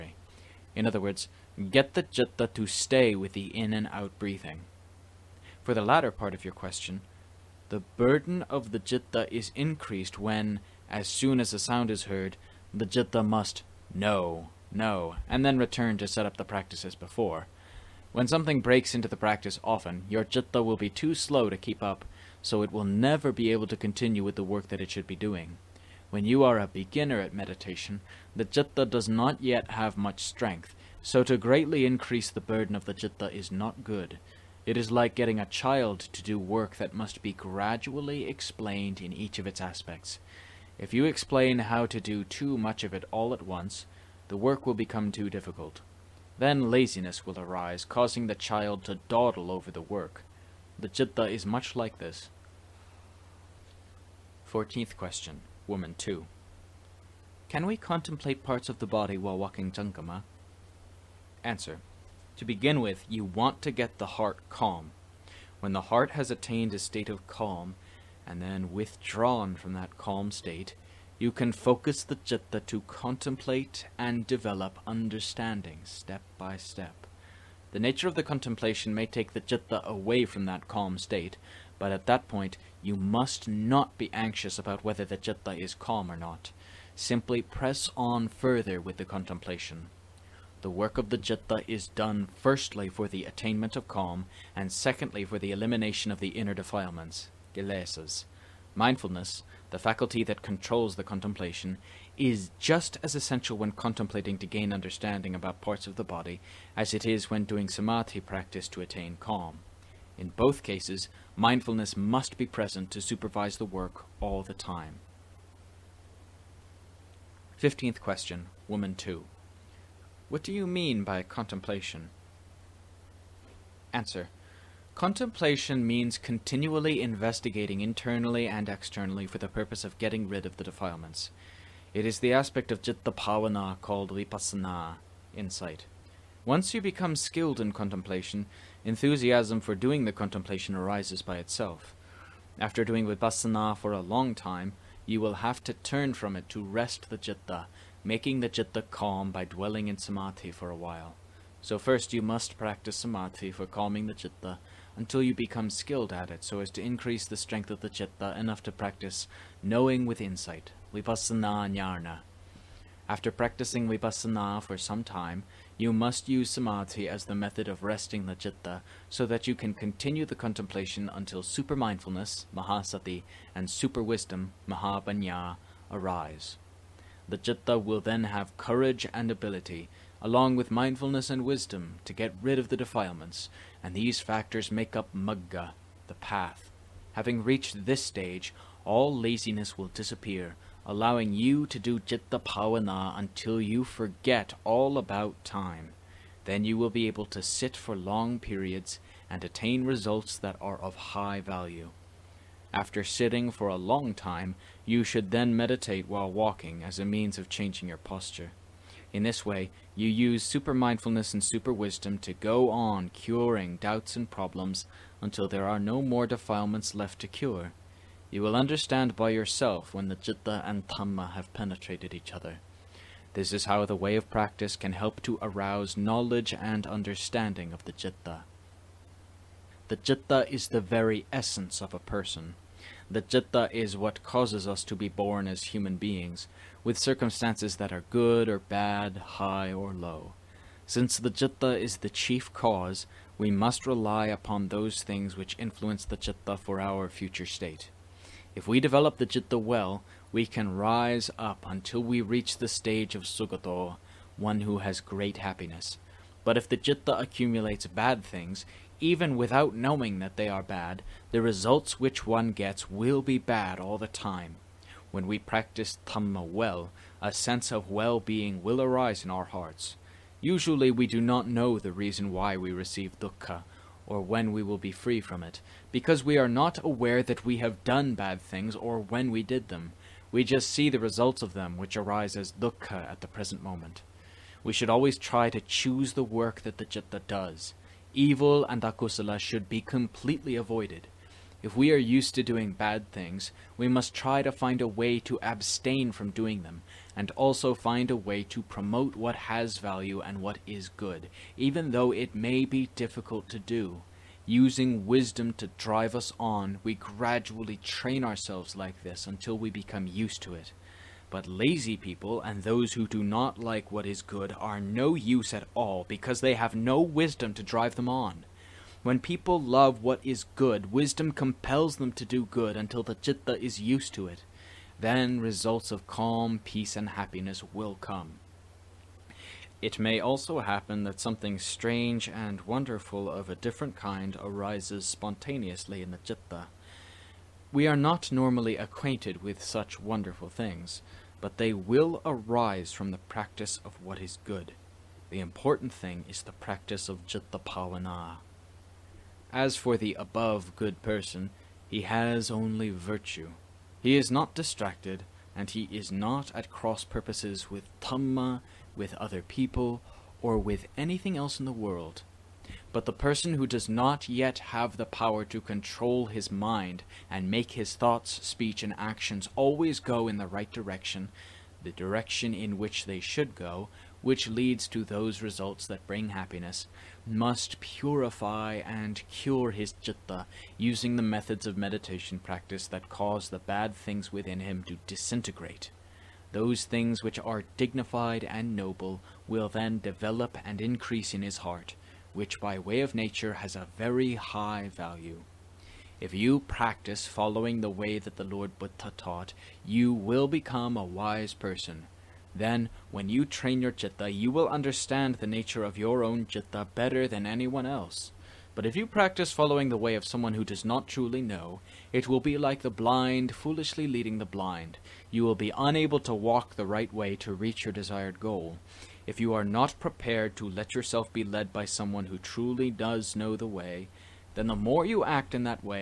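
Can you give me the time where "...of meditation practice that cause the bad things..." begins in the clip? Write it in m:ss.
6:21.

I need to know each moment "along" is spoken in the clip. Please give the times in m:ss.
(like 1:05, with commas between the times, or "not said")
3:00.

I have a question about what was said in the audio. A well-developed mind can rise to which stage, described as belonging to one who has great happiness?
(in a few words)
sugato.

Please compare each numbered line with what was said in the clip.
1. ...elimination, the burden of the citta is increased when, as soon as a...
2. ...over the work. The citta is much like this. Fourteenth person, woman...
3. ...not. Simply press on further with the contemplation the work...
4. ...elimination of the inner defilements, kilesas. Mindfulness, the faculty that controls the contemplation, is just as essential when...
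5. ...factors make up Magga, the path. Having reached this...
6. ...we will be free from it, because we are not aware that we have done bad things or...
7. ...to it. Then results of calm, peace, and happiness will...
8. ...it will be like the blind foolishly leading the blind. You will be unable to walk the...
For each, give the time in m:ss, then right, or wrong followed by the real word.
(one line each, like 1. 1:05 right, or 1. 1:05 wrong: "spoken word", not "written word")
1. 0:06 wrong: "question", not "elimination"
2. 0:49 wrong: "question", not "person"
3. 1:26 right
4. 1:35 right
5. 3:04 right
6. 4:34 right
7. 5:24 right
8. 6:52 right.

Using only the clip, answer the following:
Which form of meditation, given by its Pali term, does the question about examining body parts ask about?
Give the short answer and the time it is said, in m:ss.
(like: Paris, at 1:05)
walking jankama, at 0:59.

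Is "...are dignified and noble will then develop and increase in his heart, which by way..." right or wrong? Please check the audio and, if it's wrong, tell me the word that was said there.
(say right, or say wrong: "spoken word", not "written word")
right.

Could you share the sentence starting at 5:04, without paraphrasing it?
Using wisdom to drive us on, we gradually train ourselves like this until we become used to it.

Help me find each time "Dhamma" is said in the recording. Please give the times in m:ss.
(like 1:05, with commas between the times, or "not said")
3:40, 4:26, 5:57.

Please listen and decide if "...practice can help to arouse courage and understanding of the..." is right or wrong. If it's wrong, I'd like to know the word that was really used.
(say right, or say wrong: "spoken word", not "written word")
wrong: "knowledge", not "courage".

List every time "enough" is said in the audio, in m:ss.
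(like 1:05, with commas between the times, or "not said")
2:38.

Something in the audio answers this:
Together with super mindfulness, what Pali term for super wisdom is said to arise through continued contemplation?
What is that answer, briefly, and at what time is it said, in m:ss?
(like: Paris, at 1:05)
mahapanya, at 2:54.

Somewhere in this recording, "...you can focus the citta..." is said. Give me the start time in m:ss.
1:11.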